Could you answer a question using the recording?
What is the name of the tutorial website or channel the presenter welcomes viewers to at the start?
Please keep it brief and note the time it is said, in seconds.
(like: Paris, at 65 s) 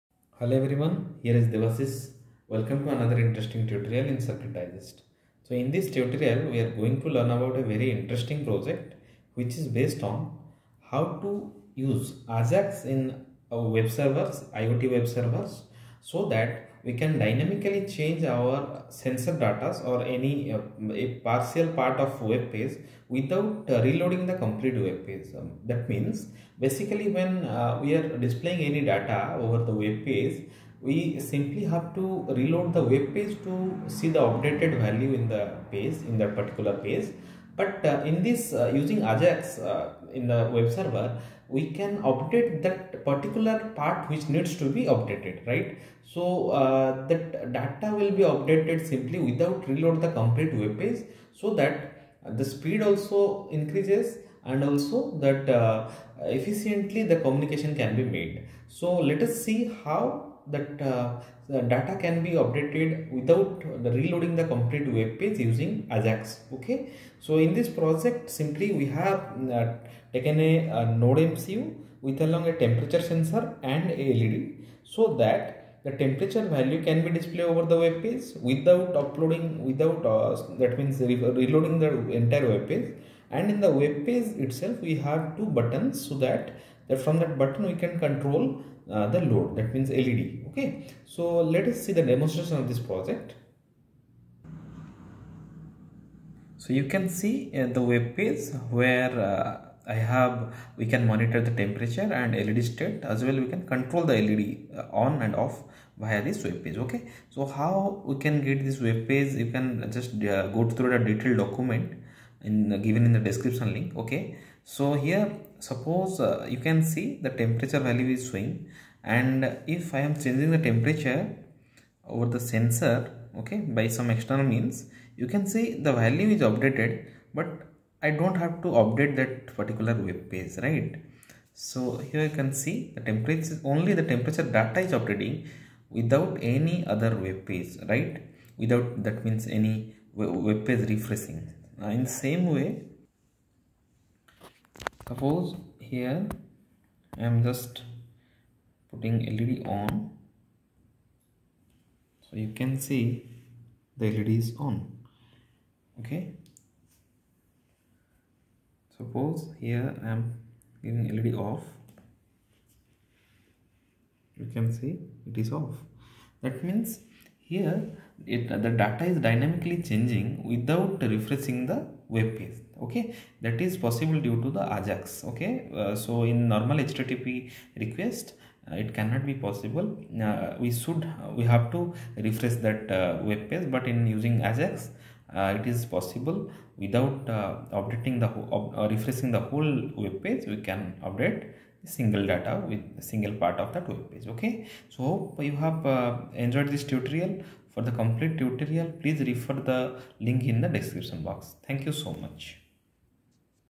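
Circuit Digest, at 4 s.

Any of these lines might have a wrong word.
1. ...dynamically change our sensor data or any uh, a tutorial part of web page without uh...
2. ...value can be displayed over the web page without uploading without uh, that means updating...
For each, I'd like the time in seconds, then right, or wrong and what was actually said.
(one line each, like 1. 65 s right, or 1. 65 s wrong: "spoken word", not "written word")
1. 17 s wrong: "partial", not "tutorial"
2. 76 s wrong: "reloading", not "updating".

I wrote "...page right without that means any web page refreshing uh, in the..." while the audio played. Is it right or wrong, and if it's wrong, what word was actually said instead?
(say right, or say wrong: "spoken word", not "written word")
right.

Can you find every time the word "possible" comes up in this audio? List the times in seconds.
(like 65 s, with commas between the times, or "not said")
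173 s, 179 s, 185 s.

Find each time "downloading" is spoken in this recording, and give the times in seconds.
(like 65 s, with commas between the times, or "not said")
not said.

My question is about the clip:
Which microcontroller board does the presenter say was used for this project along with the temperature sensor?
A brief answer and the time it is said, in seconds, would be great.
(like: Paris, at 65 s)
Node MCU, at 71 s.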